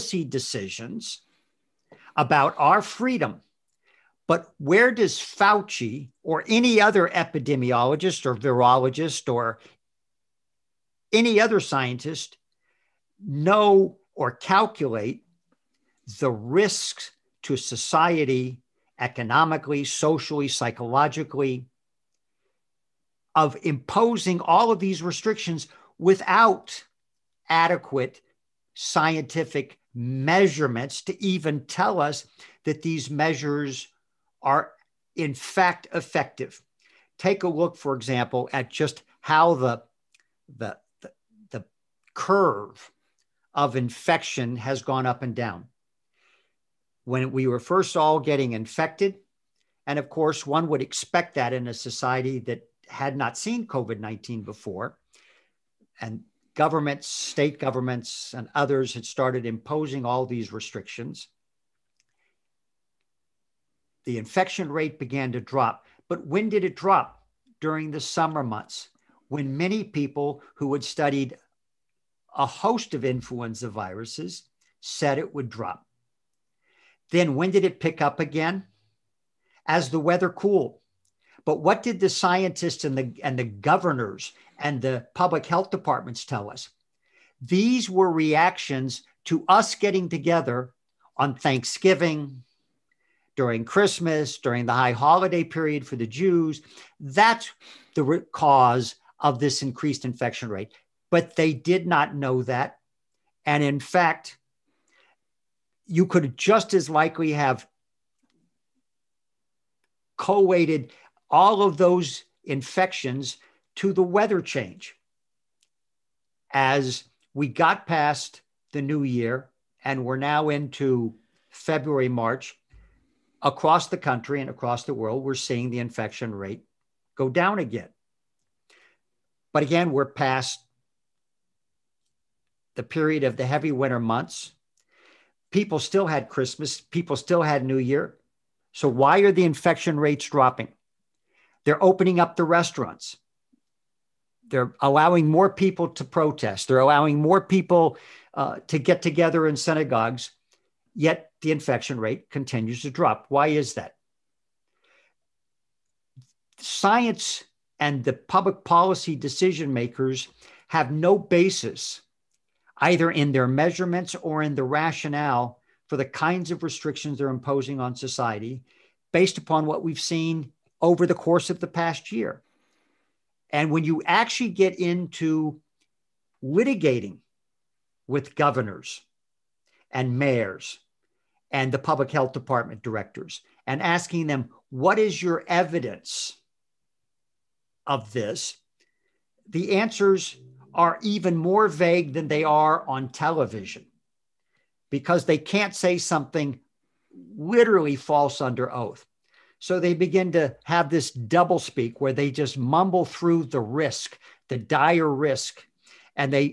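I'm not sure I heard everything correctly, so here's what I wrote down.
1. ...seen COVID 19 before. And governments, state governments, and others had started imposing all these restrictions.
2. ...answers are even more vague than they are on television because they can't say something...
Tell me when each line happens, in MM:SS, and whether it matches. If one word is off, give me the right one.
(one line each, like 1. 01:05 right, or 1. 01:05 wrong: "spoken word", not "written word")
1. 00:53 right
2. 03:09 right.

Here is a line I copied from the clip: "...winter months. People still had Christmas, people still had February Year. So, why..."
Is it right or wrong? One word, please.
wrong.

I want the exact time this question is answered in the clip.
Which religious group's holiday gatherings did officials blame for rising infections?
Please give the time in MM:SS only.
01:35.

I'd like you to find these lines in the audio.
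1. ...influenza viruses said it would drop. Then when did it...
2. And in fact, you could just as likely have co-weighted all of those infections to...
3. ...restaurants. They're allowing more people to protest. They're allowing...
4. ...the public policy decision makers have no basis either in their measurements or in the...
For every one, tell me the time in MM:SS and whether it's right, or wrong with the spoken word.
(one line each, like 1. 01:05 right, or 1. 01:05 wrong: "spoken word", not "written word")
1. 01:13 right
2. 01:43 right
3. 02:22 right
4. 02:38 right.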